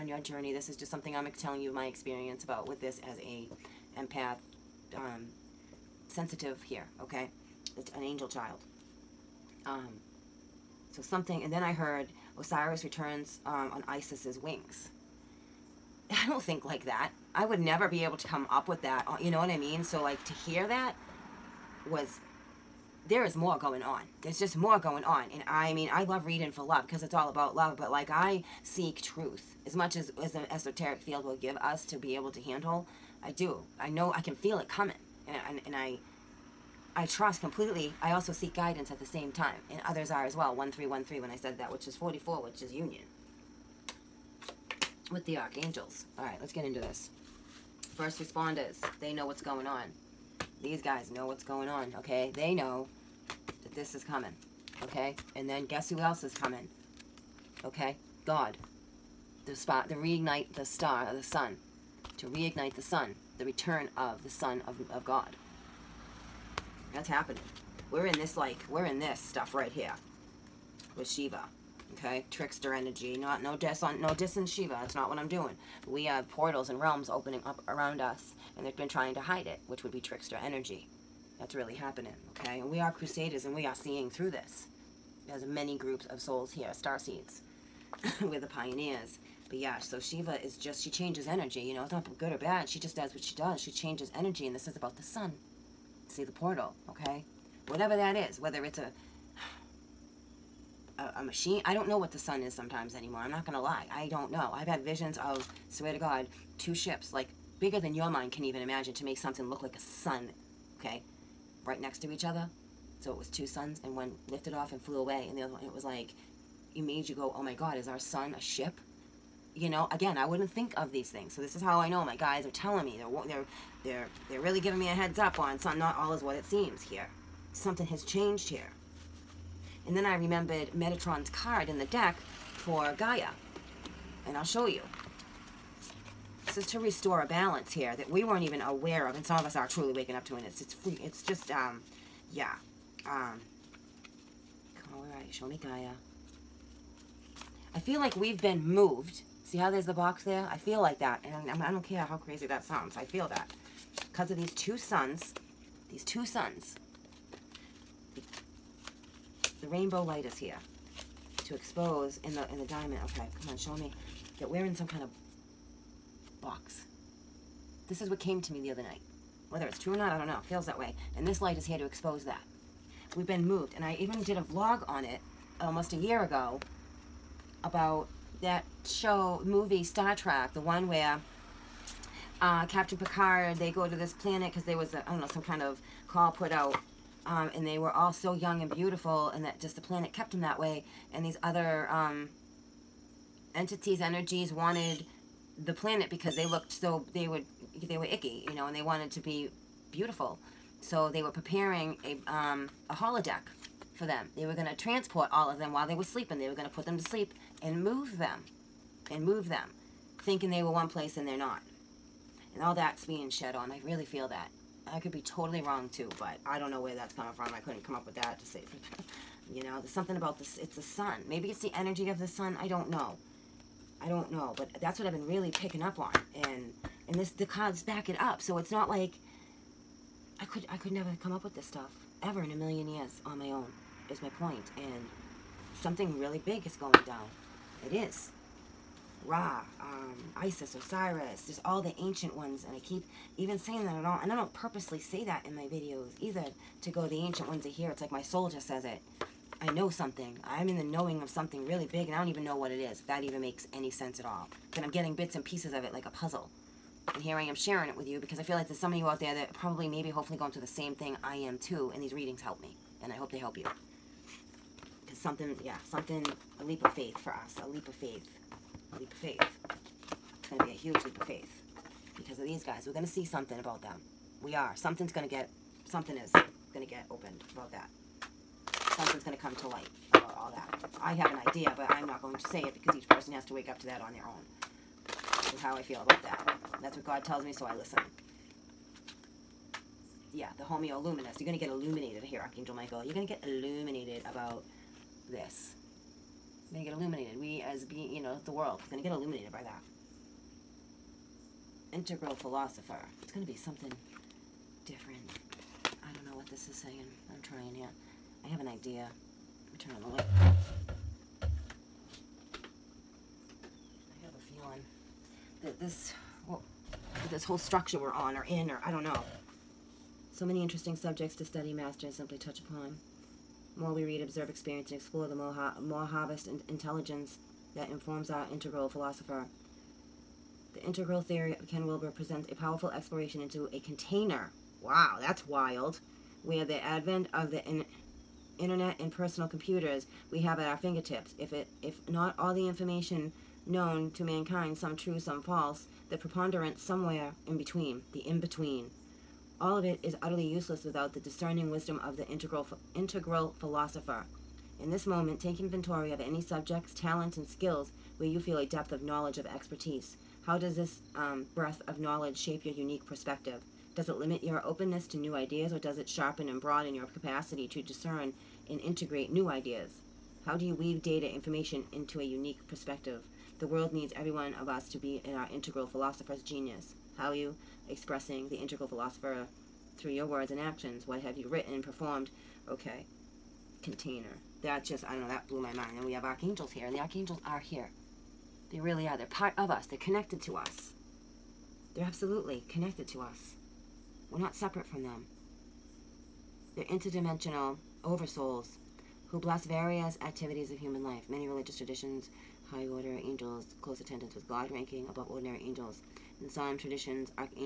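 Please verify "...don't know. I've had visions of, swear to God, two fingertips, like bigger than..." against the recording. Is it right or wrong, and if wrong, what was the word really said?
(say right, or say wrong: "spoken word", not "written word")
wrong: "ships", not "fingertips".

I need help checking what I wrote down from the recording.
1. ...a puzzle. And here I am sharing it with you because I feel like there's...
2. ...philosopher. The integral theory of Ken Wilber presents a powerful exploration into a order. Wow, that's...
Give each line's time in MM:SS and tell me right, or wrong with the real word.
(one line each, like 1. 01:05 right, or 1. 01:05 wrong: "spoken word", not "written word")
1. 04:16 right
2. 05:28 wrong: "container", not "order".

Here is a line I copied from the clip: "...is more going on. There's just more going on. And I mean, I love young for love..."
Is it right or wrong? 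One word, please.
wrong.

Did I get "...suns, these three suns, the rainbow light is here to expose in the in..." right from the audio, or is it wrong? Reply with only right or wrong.
wrong.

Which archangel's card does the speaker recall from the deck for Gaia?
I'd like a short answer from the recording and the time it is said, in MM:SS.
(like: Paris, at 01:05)
Metatron, at 02:10.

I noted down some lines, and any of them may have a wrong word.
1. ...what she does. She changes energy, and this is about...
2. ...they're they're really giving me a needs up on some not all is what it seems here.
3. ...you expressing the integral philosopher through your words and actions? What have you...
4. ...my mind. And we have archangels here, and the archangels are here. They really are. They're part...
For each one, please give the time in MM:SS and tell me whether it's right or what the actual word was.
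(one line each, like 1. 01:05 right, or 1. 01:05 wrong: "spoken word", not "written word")
1. 01:33 right
2. 02:03 wrong: "heads", not "needs"
3. 06:17 right
4. 06:25 right.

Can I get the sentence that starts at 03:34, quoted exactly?
I could be totally wrong too, but I don't know where that's coming from.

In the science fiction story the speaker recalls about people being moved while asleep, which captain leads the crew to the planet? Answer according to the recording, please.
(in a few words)
Captain Picard.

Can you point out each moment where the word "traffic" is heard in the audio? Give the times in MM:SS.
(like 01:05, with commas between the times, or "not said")
not said.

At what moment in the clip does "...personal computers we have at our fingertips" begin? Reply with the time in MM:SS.
05:39.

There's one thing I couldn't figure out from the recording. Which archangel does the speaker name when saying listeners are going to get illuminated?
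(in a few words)
Archangel Michael.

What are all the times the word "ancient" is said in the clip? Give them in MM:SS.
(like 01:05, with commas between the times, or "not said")
04:01, 04:07.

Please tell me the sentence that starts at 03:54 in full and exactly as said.
And something really big is going down.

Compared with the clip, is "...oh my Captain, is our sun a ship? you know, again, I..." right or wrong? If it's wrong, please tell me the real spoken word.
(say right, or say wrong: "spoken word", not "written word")
wrong: "God", not "Captain".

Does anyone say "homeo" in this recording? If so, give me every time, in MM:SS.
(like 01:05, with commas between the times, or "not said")
04:50.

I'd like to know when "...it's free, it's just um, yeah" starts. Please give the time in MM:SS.
02:20.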